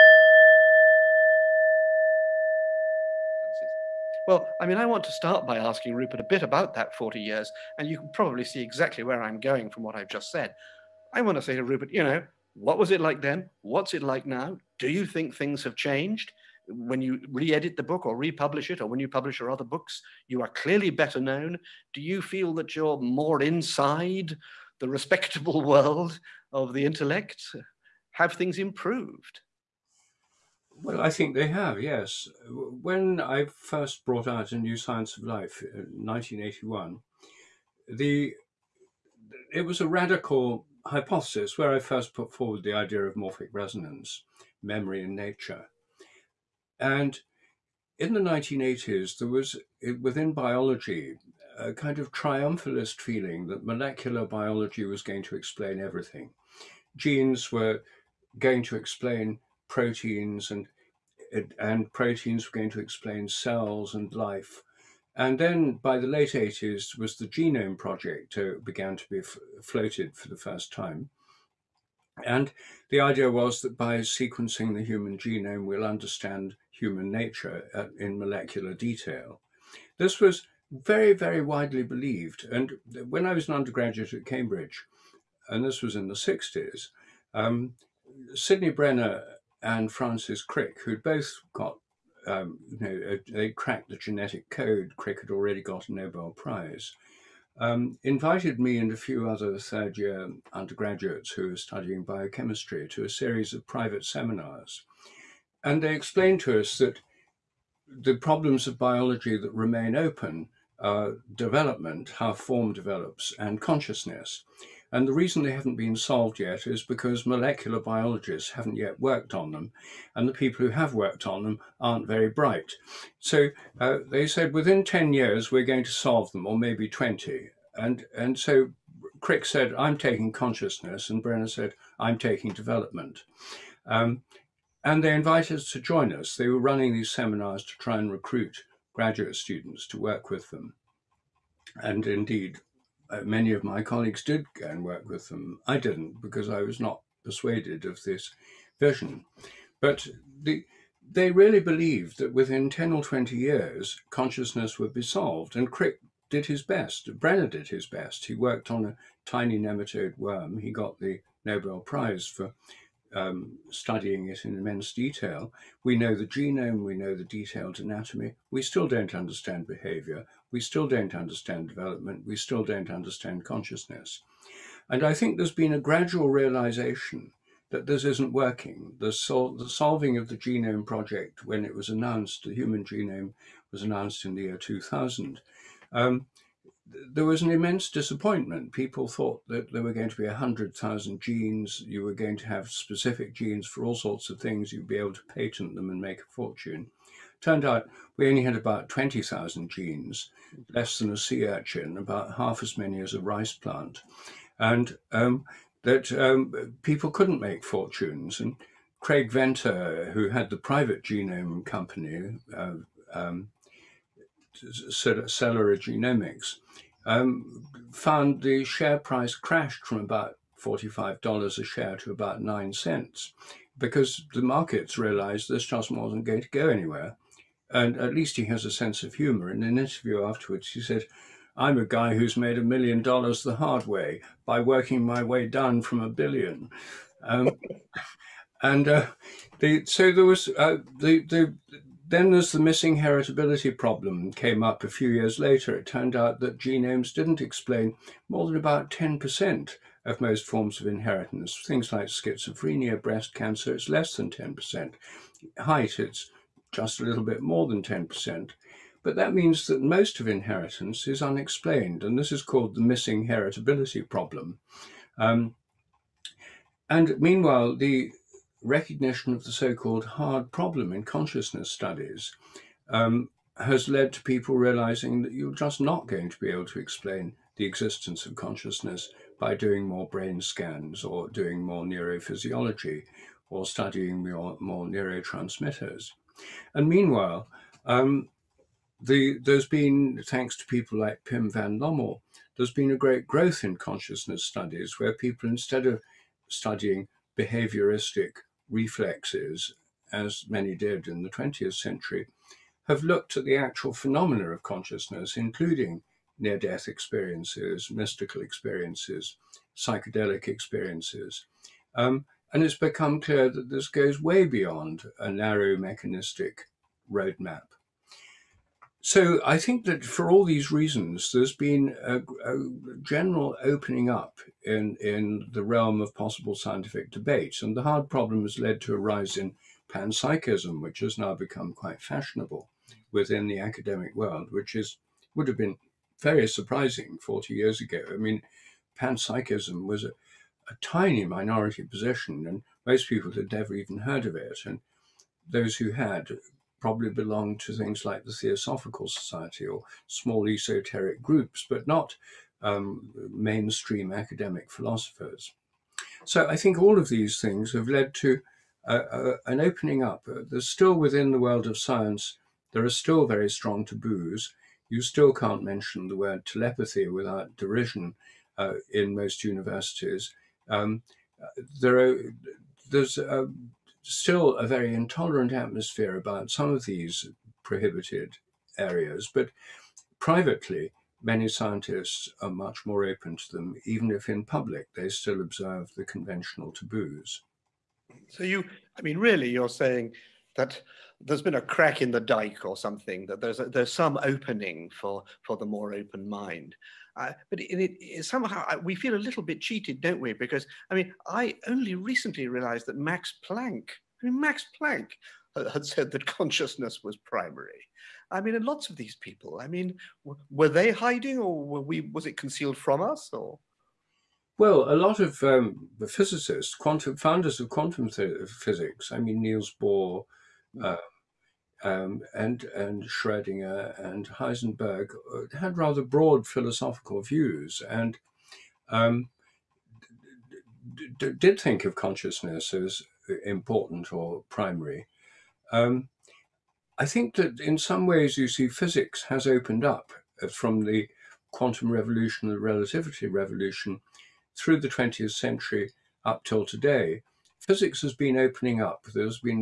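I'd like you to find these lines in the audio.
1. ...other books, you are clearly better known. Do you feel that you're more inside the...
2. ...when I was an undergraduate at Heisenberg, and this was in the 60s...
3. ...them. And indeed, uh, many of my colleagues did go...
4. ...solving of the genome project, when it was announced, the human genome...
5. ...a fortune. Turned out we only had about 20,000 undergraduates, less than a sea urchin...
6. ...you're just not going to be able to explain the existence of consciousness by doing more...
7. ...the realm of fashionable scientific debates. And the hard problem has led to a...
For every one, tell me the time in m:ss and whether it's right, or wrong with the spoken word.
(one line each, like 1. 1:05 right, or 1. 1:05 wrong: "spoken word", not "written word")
1. 0:19 right
2. 1:23 wrong: "Cambridge", not "Heisenberg"
3. 2:20 right
4. 2:59 right
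5. 3:16 wrong: "genes", not "undergraduates"
6. 4:35 right
7. 5:25 wrong: "possible", not "fashionable".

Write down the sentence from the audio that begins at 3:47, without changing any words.
And at least he has a sense of humor.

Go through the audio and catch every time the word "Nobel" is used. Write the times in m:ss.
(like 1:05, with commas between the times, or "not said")
1:35, 2:41.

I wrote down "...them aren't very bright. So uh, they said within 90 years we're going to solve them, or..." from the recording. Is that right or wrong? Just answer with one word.
wrong.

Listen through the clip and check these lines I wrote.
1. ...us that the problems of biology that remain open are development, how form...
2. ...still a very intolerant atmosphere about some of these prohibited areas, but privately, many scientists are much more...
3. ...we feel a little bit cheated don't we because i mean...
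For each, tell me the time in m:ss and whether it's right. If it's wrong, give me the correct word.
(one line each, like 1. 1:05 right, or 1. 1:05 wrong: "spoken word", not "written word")
1. 1:46 right
2. 6:14 right
3. 6:38 right.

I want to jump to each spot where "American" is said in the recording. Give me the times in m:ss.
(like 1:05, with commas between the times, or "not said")
not said.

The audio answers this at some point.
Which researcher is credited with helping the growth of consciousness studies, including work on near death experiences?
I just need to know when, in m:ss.
4:51.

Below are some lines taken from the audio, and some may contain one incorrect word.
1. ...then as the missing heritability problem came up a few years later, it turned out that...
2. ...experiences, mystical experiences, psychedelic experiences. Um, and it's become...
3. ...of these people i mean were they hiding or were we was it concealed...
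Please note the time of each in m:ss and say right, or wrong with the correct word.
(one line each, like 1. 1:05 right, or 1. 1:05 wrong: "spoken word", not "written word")
1. 4:02 right
2. 5:06 right
3. 6:48 right.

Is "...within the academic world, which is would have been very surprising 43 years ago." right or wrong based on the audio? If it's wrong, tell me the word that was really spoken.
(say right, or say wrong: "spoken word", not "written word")
wrong: "40", not "43".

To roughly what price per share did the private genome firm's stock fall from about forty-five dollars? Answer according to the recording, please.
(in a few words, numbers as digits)
9 cents.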